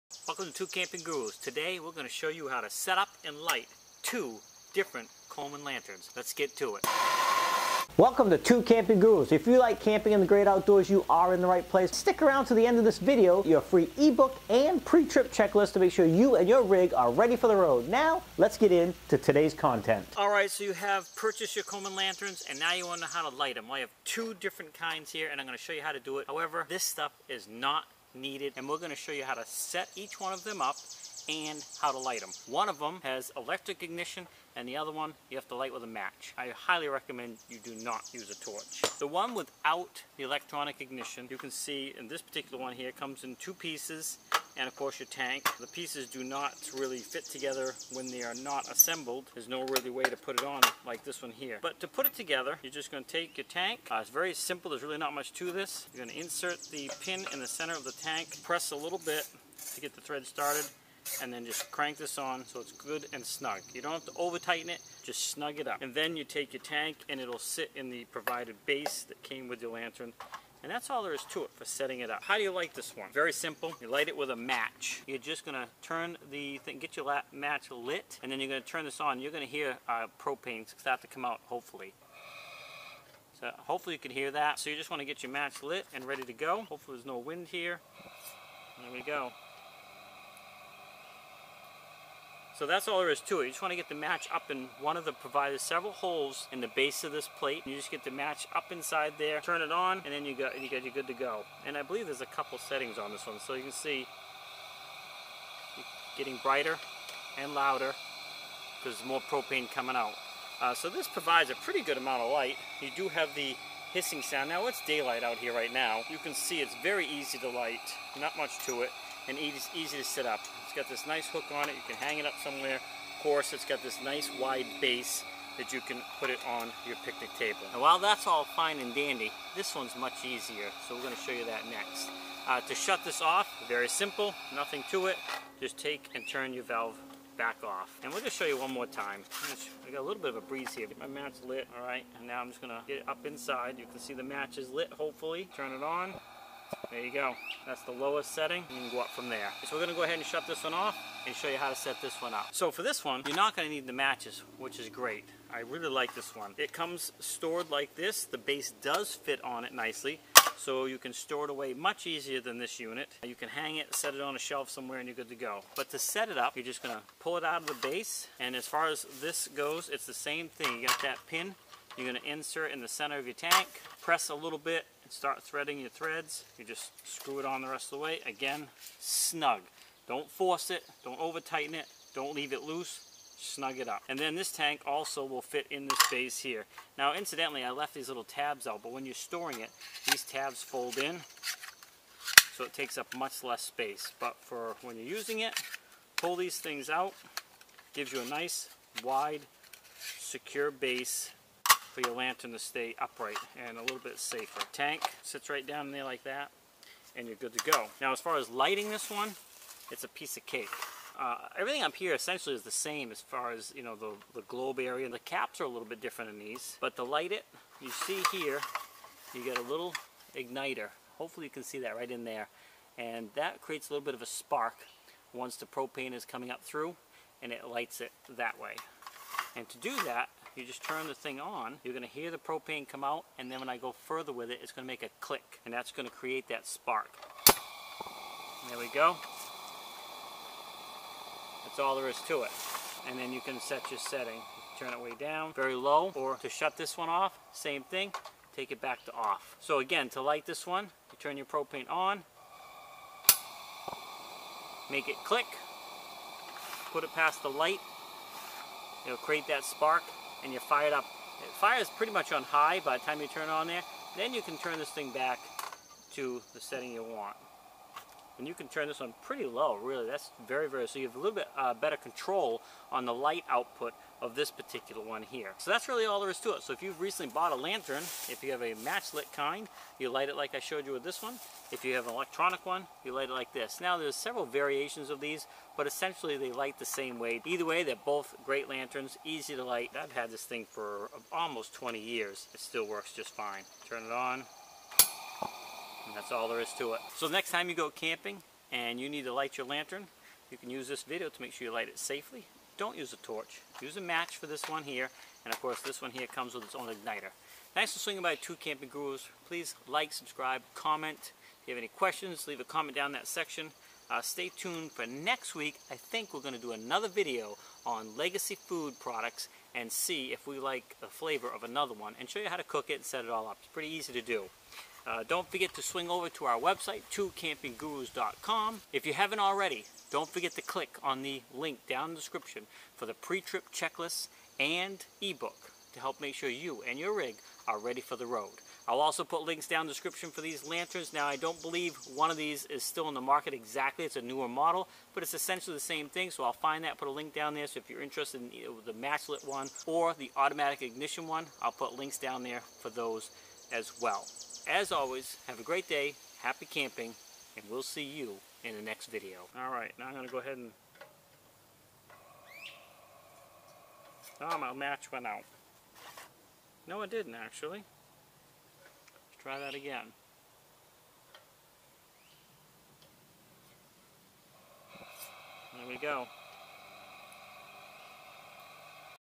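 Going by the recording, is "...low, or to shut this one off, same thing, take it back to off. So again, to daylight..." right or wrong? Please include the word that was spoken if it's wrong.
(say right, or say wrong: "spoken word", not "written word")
wrong: "light", not "daylight".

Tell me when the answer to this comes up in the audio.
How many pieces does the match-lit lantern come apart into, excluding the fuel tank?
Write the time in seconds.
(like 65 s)
43 s.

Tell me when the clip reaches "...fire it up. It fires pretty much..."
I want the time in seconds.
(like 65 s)
260 s.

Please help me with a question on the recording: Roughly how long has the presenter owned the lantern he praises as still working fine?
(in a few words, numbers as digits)
Almost 20 years.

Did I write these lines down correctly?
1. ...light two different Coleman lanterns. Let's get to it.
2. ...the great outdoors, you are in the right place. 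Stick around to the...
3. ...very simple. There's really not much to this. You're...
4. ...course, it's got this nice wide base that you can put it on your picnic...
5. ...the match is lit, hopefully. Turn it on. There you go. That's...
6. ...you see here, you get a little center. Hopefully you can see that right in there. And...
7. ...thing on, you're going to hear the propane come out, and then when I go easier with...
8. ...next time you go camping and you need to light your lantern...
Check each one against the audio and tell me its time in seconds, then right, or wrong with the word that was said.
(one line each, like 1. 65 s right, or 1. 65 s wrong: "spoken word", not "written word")
1. 3 s right
2. 10 s right
3. 54 s right
4. 123 s right
5. 144 s right
6. 217 s wrong: "igniter", not "center"
7. 231 s wrong: "further", not "easier"
8. 297 s right.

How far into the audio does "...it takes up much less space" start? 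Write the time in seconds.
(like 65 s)
192 s.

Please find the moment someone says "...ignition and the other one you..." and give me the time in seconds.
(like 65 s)
33 s.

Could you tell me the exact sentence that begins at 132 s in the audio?
Uh, to shut this off, very simple, nothing to it.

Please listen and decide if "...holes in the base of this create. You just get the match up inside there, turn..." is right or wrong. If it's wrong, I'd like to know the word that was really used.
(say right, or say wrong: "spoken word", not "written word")
wrong: "plate", not "create".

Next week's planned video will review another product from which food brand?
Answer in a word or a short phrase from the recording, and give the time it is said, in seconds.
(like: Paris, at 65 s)
Legacy, at 318 s.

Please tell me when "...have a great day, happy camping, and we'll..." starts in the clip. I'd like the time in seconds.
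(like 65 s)
355 s.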